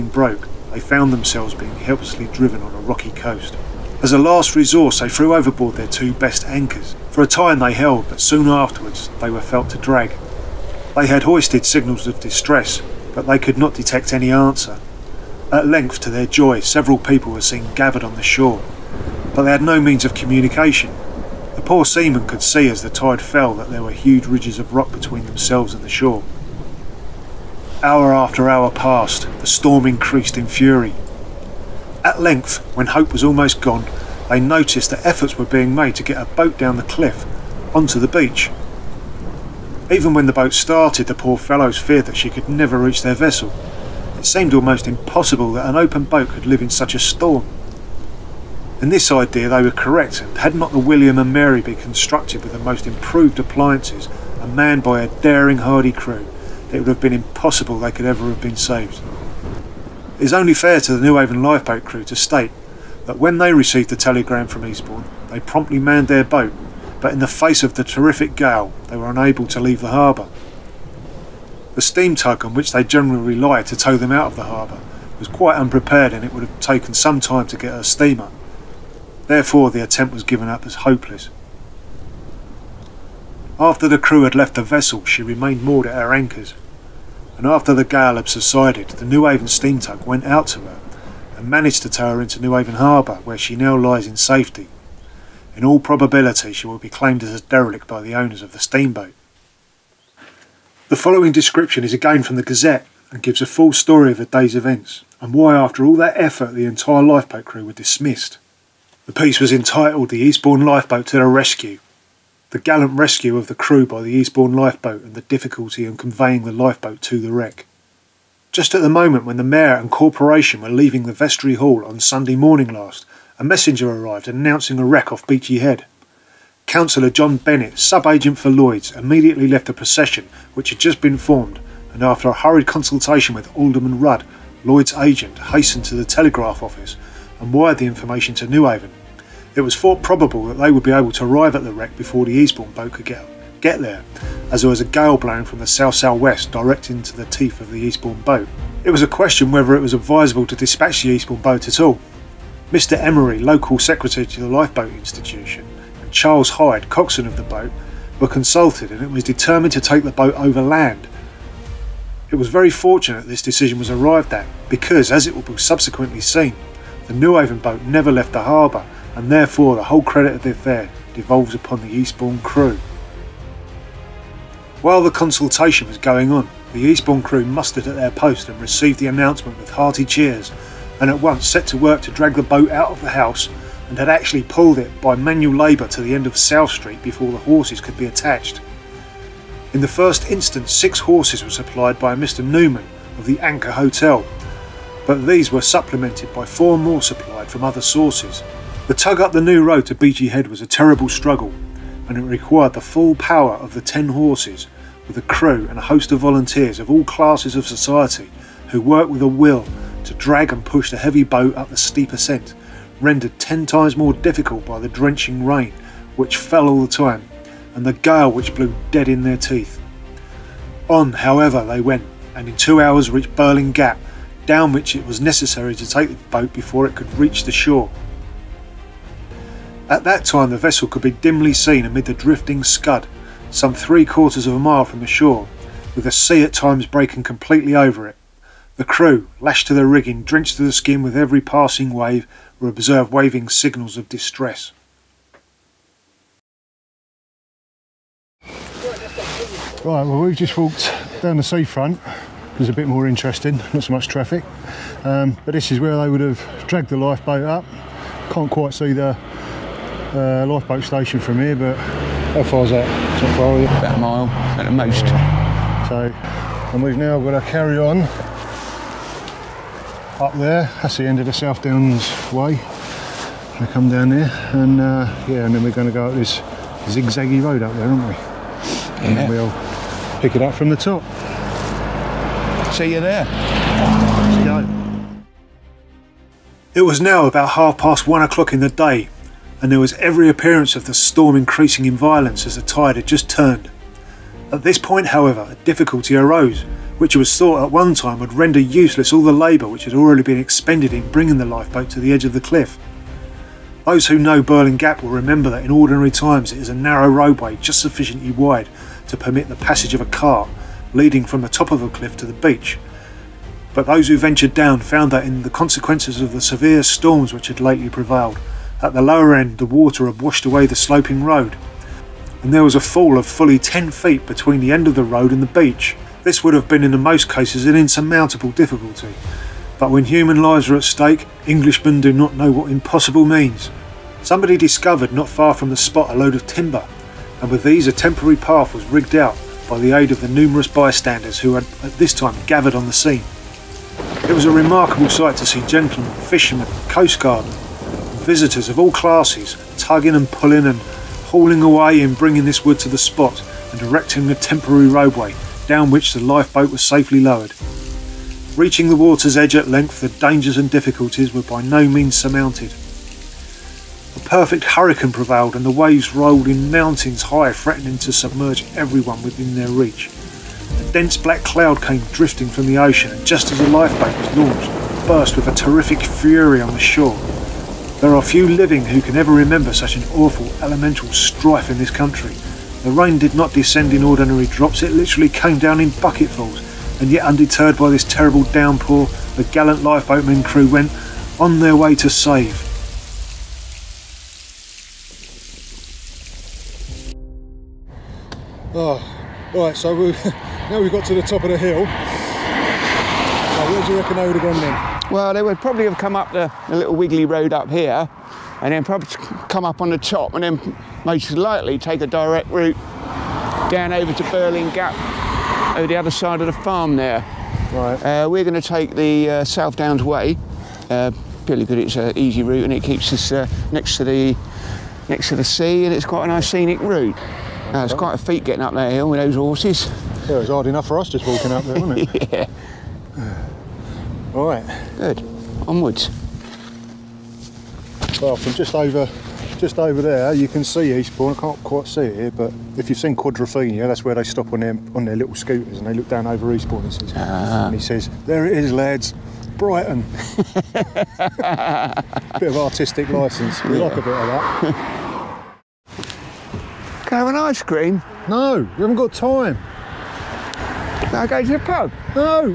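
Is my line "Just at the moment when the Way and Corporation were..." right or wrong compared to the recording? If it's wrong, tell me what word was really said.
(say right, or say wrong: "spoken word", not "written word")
wrong: "Mayor", not "Way".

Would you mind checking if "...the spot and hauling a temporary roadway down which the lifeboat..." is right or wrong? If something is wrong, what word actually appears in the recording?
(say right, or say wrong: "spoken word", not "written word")
wrong: "erecting", not "hauling".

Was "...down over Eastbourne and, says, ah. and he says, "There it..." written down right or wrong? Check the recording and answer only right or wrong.
right.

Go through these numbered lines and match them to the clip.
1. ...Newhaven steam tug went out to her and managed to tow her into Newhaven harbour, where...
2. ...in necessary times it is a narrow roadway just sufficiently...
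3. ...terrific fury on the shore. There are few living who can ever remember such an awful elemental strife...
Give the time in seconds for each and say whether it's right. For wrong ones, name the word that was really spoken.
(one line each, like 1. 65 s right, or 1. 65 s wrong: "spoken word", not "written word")
1. 89 s right
2. 305 s wrong: "ordinary", not "necessary"
3. 375 s right.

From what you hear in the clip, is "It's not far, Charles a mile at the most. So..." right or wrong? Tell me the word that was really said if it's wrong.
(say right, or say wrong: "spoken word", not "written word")
wrong: "About", not "Charles".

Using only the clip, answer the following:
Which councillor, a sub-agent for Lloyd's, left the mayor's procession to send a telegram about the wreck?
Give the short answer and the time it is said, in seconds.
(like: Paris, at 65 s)
John Bennett, at 127 s.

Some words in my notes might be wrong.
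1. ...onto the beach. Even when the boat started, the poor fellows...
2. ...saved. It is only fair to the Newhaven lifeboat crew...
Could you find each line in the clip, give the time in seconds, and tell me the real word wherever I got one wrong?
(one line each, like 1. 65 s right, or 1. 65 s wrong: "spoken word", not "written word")
1. 37 s right
2. 58 s right.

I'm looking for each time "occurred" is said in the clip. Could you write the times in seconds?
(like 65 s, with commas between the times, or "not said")
not said.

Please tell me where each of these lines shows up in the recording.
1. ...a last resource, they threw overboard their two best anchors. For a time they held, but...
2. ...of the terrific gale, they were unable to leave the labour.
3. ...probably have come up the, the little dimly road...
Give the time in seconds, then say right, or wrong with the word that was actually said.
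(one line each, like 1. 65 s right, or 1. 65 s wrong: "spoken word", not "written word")
1. 4 s right
2. 67 s wrong: "harbour", not "labour"
3. 405 s wrong: "wiggly", not "dimly".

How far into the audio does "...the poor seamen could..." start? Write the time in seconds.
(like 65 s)
21 s.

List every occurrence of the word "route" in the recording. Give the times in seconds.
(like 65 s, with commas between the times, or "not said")
412 s, 422 s, 426 s.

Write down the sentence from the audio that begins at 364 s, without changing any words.
A perfect hurricane prevailed and the waves rolled in mountains high, threatening to submerge everyone within their reach.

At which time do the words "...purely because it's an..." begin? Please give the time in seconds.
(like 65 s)
421 s.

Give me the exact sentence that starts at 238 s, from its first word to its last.
The crew, lashed to the rigging, drenched to the skin with every passing wave, were observed waving signals of distress.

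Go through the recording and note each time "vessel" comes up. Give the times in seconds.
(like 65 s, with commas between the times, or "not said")
43 s, 84 s, 230 s.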